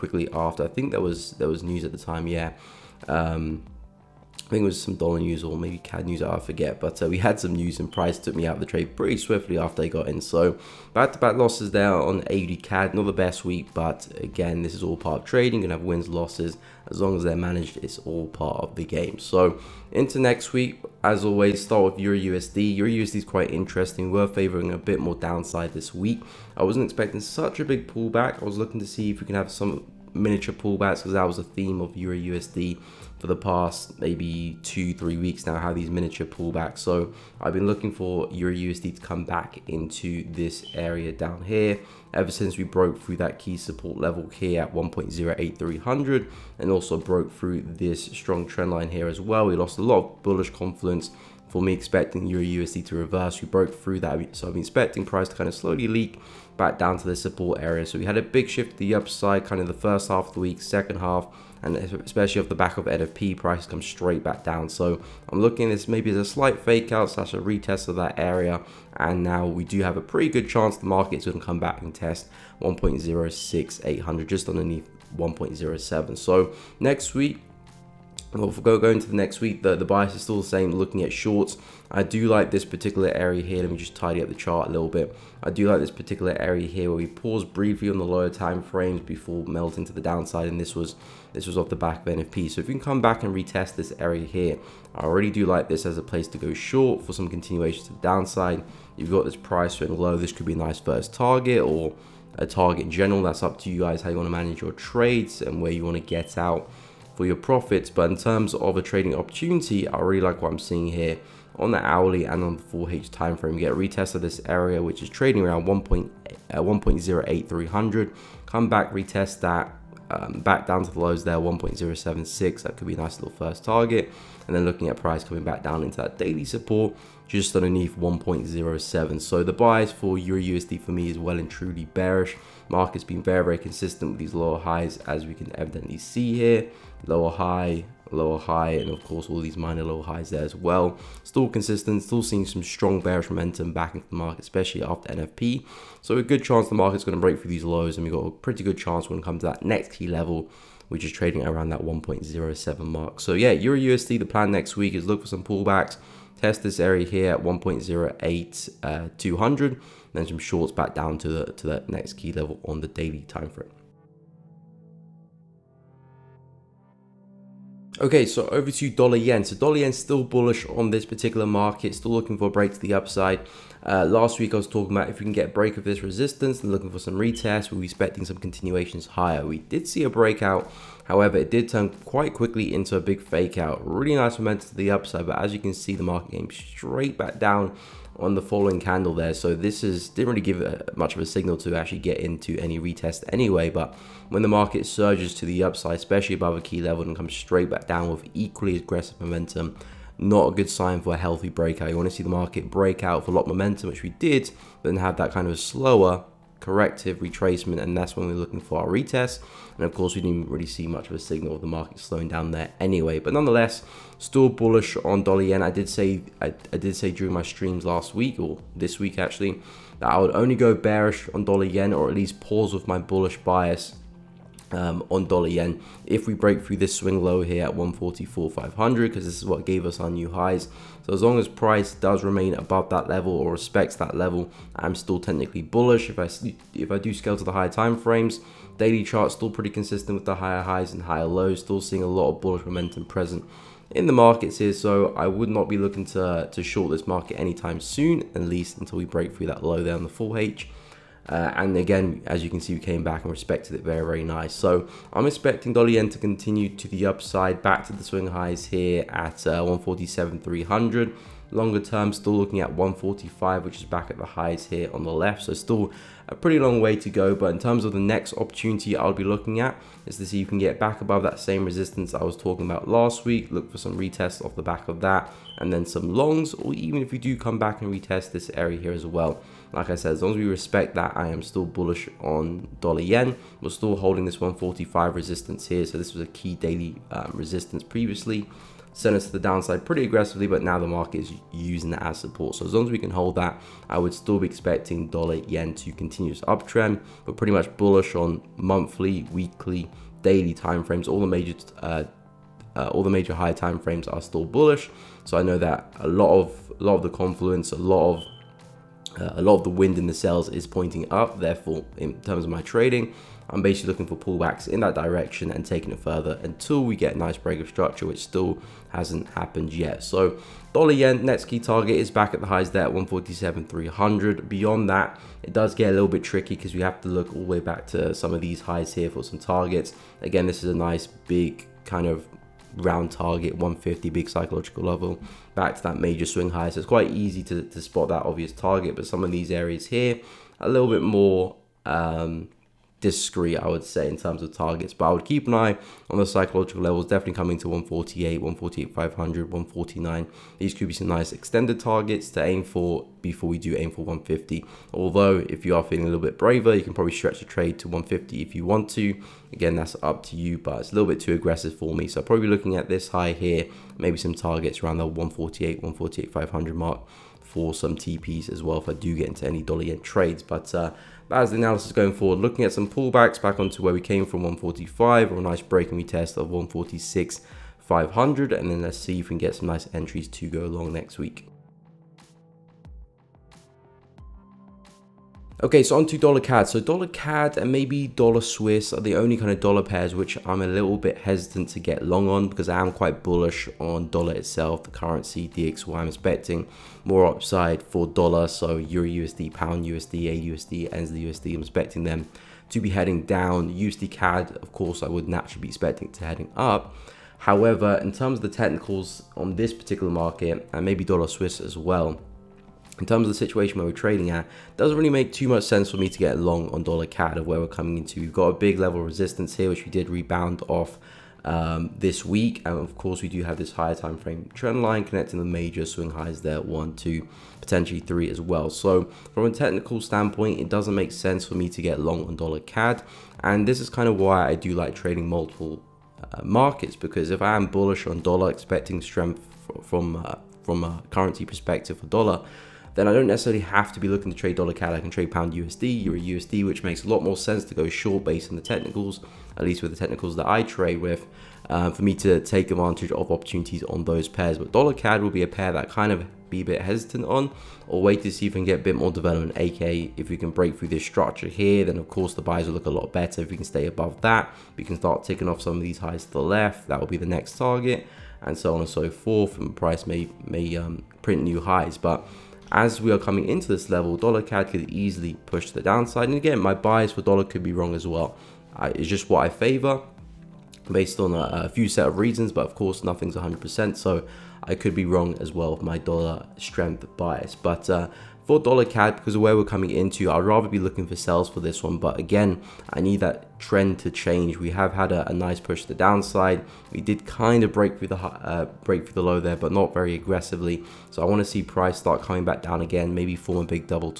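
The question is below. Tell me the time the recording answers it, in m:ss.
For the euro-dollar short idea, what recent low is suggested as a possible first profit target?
2:01.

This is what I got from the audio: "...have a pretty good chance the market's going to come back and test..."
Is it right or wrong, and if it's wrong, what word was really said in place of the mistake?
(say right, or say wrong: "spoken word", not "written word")
right.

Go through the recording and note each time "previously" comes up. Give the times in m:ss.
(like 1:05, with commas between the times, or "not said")
4:47.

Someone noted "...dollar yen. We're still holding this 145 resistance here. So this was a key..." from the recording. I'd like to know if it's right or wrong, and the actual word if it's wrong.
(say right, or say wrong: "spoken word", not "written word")
right.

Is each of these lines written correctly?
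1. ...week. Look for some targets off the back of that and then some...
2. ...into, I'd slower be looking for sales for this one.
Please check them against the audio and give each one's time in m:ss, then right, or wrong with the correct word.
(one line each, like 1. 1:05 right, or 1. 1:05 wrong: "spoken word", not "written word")
1. 4:33 wrong: "retests", not "targets"
2. 8:09 wrong: "rather", not "slower".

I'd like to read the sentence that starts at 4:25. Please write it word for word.
So still a pretty long way to go.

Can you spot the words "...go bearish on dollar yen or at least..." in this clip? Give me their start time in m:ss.
3:40.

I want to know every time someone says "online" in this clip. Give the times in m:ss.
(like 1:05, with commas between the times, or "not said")
not said.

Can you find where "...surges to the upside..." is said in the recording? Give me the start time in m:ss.
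3:14.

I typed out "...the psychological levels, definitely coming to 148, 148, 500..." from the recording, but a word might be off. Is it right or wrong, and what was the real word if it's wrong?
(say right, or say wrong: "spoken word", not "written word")
right.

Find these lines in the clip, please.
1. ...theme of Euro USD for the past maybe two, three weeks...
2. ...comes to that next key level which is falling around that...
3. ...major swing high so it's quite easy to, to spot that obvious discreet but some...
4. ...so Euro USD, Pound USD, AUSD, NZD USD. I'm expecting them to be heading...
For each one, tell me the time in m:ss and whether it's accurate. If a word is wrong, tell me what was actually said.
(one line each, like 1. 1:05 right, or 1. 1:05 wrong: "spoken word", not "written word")
1. 0:31 right
2. 2:29 wrong: "trading", not "falling"
3. 5:35 wrong: "target", not "discreet"
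4. 6:38 right.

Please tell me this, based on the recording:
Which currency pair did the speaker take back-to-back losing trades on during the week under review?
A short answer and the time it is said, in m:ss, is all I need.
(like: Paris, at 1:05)
AUD CAD, at 0:12.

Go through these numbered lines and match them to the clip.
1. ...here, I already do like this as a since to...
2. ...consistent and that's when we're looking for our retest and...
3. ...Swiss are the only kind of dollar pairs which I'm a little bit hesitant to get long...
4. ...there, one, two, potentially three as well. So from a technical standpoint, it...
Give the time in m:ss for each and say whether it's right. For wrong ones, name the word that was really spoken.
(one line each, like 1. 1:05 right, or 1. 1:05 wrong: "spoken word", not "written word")
1. 1:34 wrong: "place", not "since"
2. 3:27 wrong: "retracement", not "consistent"
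3. 6:28 right
4. 7:06 right.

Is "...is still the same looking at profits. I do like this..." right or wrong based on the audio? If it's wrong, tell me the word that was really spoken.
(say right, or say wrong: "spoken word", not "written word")
wrong: "shorts", not "profits".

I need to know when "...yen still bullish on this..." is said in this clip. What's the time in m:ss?
2:49.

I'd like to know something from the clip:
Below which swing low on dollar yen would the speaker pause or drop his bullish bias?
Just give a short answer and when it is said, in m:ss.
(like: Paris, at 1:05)
144.500, at 3:47.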